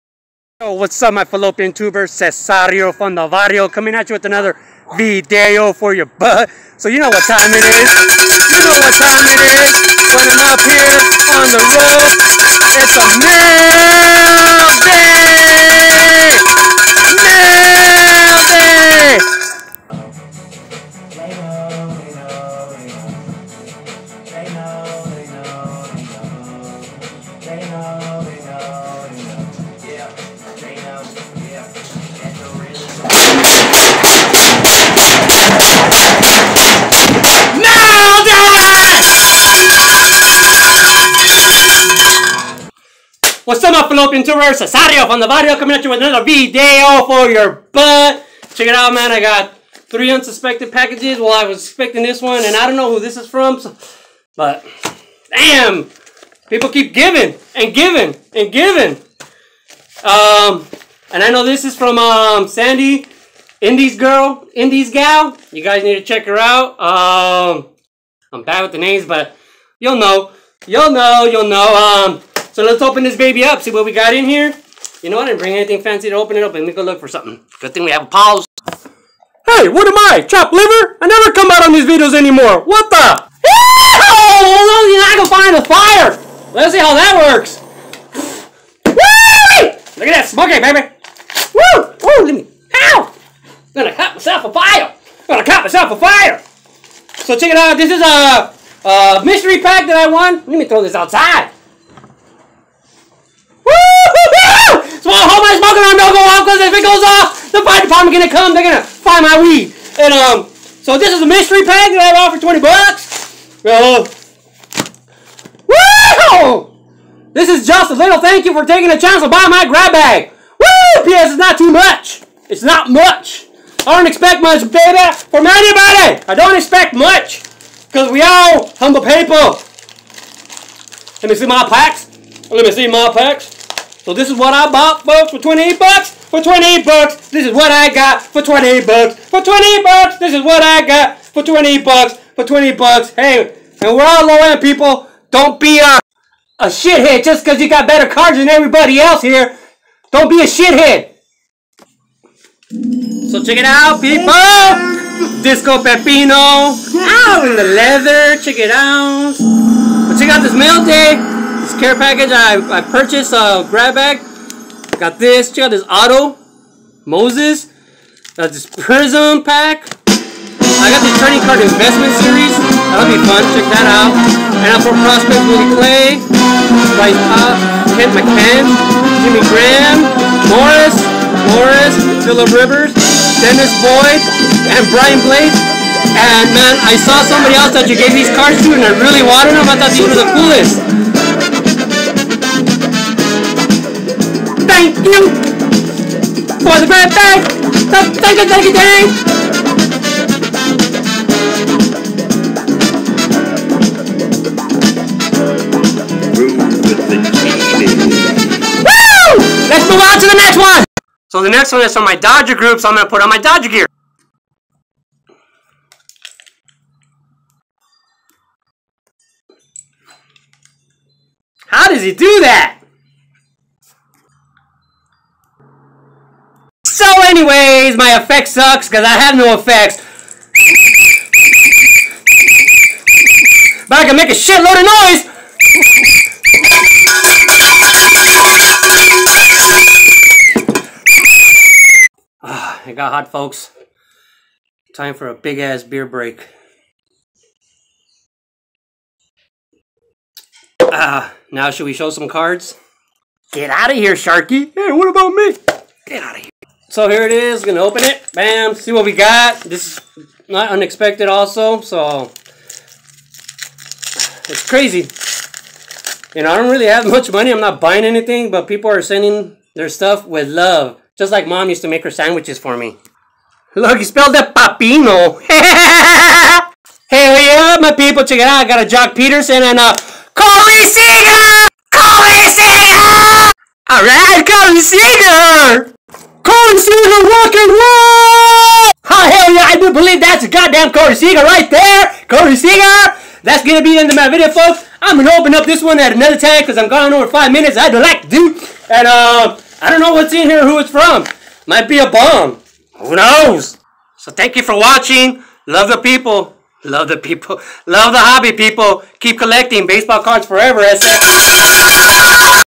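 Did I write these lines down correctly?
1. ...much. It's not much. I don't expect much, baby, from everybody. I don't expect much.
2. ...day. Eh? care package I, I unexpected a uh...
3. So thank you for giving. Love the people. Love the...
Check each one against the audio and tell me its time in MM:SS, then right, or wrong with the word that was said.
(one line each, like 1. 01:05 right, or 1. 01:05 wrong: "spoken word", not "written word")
1. 02:01 wrong: "anybody", not "everybody"
2. 02:40 wrong: "purchased", not "unexpected"
3. 05:04 wrong: "watching", not "giving".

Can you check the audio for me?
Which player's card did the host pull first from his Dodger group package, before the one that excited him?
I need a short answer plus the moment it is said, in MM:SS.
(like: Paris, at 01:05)
Joc Pederson, at 04:38.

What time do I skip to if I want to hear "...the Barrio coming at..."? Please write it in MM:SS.
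00:45.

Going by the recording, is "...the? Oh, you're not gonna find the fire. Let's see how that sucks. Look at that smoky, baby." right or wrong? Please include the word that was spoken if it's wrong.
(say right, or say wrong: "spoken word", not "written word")
wrong: "works", not "sucks".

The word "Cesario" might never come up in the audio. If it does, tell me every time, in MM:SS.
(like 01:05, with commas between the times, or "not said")
00:02, 00:44.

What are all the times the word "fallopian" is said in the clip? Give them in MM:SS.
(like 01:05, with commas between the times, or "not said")
00:01, 00:43.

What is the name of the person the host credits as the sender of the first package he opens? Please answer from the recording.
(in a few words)
Sandy.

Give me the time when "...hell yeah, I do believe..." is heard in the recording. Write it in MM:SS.
04:49.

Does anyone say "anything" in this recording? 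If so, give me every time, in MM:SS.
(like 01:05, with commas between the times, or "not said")
01:15, 04:28.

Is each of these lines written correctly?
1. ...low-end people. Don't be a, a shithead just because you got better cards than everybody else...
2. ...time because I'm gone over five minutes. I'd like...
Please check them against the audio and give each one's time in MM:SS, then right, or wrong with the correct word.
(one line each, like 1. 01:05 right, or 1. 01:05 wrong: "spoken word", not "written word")
1. 02:24 right
2. 04:56 right.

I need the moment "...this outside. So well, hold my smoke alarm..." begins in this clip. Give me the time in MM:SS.
01:40.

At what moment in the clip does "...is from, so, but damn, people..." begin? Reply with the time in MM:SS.
00:53.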